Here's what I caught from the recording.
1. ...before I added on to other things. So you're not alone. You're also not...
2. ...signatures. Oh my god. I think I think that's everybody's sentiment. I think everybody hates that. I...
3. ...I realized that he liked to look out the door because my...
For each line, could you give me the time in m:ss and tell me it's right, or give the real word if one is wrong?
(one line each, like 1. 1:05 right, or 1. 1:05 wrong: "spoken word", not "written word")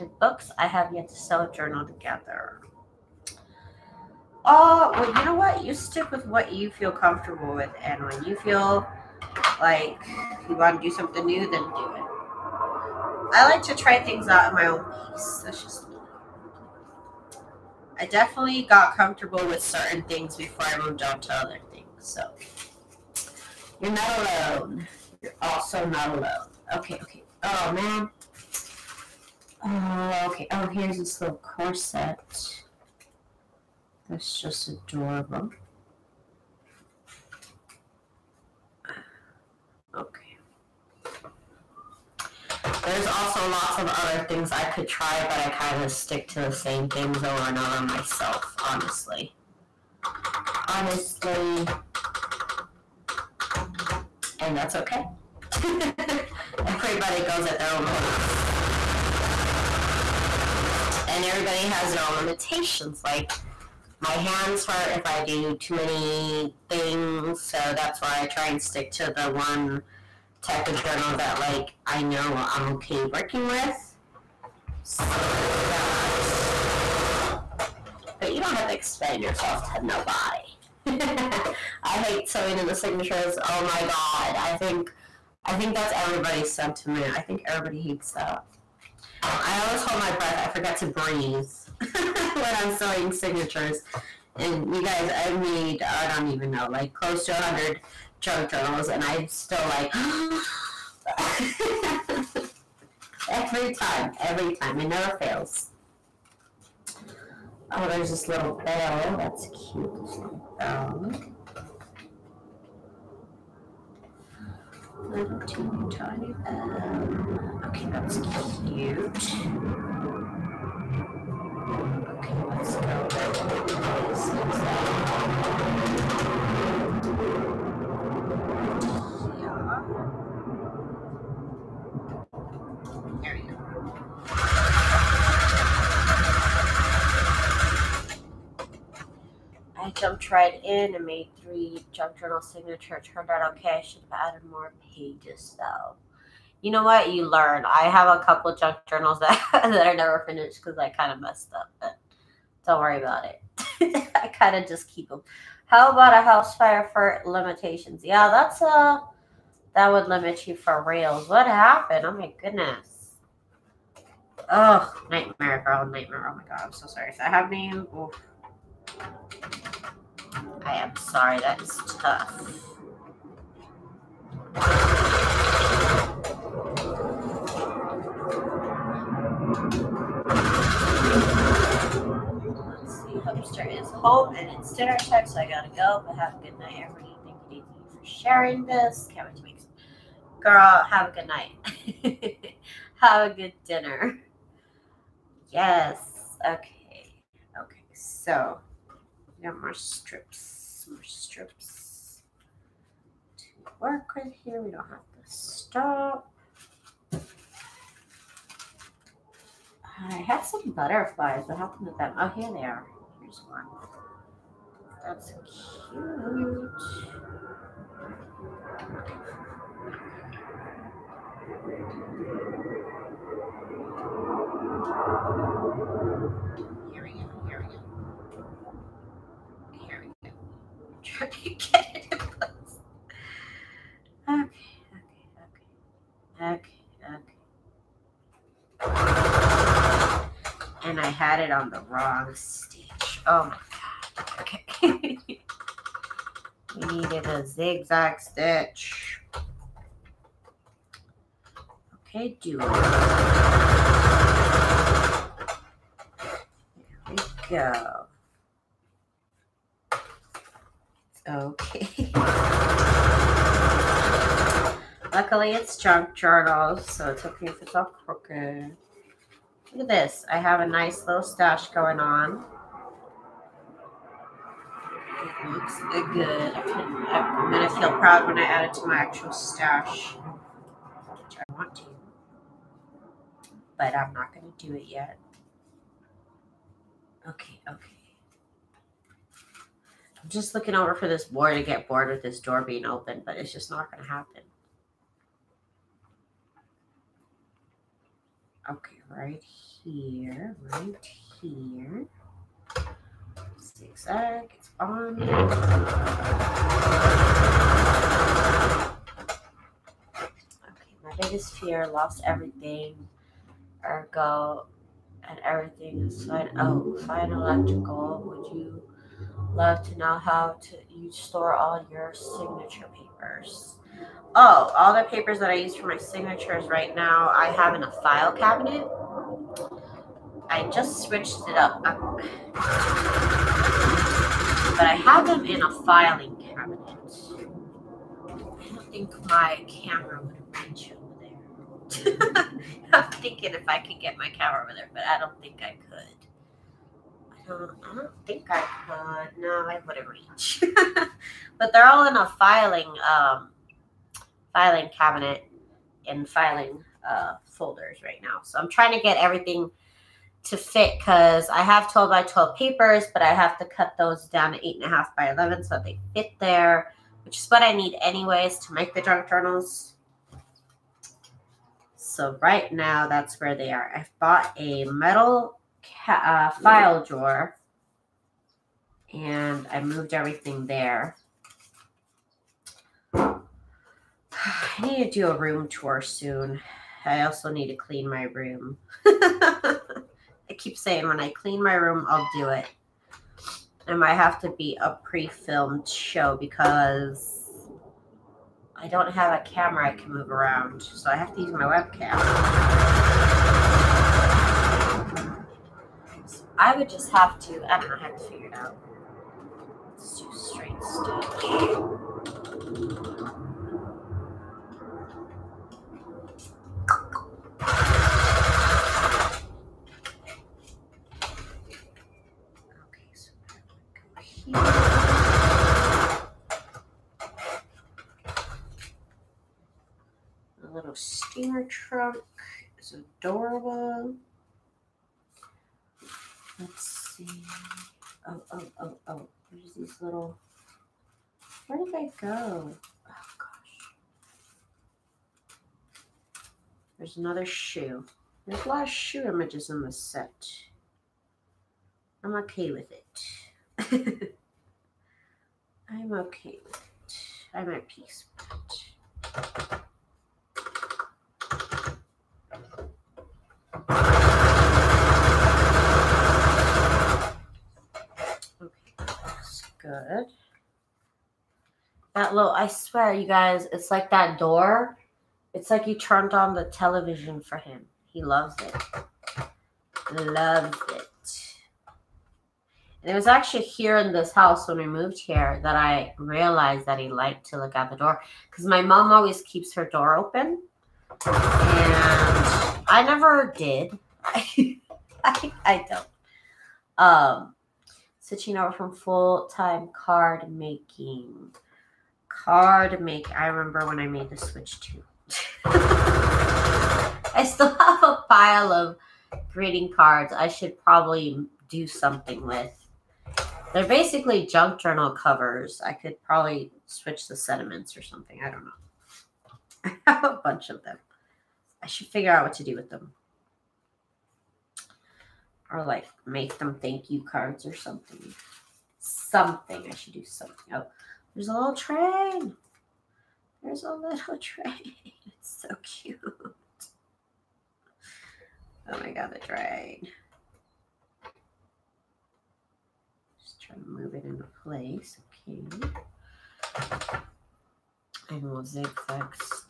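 1. 0:20 wrong: "moved", not "added"
2. 1:22 right
3. 8:05 right.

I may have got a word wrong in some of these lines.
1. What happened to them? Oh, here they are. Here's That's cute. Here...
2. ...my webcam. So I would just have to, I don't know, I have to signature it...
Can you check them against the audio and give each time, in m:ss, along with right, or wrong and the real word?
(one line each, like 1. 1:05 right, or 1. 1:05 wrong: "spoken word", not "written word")
1. 3:31 right
2. 6:41 wrong: "figure", not "signature".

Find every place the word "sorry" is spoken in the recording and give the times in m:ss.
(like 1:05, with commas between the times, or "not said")
2:46, 2:50.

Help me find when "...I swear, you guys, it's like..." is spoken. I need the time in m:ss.
7:52.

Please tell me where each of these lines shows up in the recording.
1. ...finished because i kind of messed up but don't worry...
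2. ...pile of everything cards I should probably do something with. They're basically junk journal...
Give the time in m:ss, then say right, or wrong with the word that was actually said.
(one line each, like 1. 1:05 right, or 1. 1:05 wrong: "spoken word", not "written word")
1. 2:30 right
2. 8:28 wrong: "greeting", not "everything".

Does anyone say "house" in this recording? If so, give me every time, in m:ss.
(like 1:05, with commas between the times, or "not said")
2:36, 8:04.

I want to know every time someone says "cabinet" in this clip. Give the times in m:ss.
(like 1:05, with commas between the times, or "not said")
5:28, 5:36, 5:54.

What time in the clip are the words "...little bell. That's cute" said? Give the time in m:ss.
1:48.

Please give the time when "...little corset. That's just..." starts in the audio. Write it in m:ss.
0:31.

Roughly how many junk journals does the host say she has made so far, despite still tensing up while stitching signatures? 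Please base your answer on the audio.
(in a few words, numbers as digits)
100.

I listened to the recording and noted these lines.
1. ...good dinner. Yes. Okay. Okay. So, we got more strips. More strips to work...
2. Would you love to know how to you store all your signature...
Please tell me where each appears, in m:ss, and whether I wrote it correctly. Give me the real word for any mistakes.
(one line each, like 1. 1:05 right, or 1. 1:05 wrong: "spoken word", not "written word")
1. 3:13 right
2. 5:18 right.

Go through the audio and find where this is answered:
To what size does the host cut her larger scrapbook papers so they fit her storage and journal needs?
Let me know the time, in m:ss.
6:04.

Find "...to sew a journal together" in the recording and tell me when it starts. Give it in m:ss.
0:01.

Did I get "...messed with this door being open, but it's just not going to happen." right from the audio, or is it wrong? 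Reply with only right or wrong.
wrong.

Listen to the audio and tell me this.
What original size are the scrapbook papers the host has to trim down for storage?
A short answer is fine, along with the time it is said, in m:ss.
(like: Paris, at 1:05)
12 by 12, at 6:01.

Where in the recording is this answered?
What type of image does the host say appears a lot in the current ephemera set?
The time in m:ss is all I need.
7:28.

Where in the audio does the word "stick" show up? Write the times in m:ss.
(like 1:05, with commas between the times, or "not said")
0:05, 0:45, 1:08, 4:02.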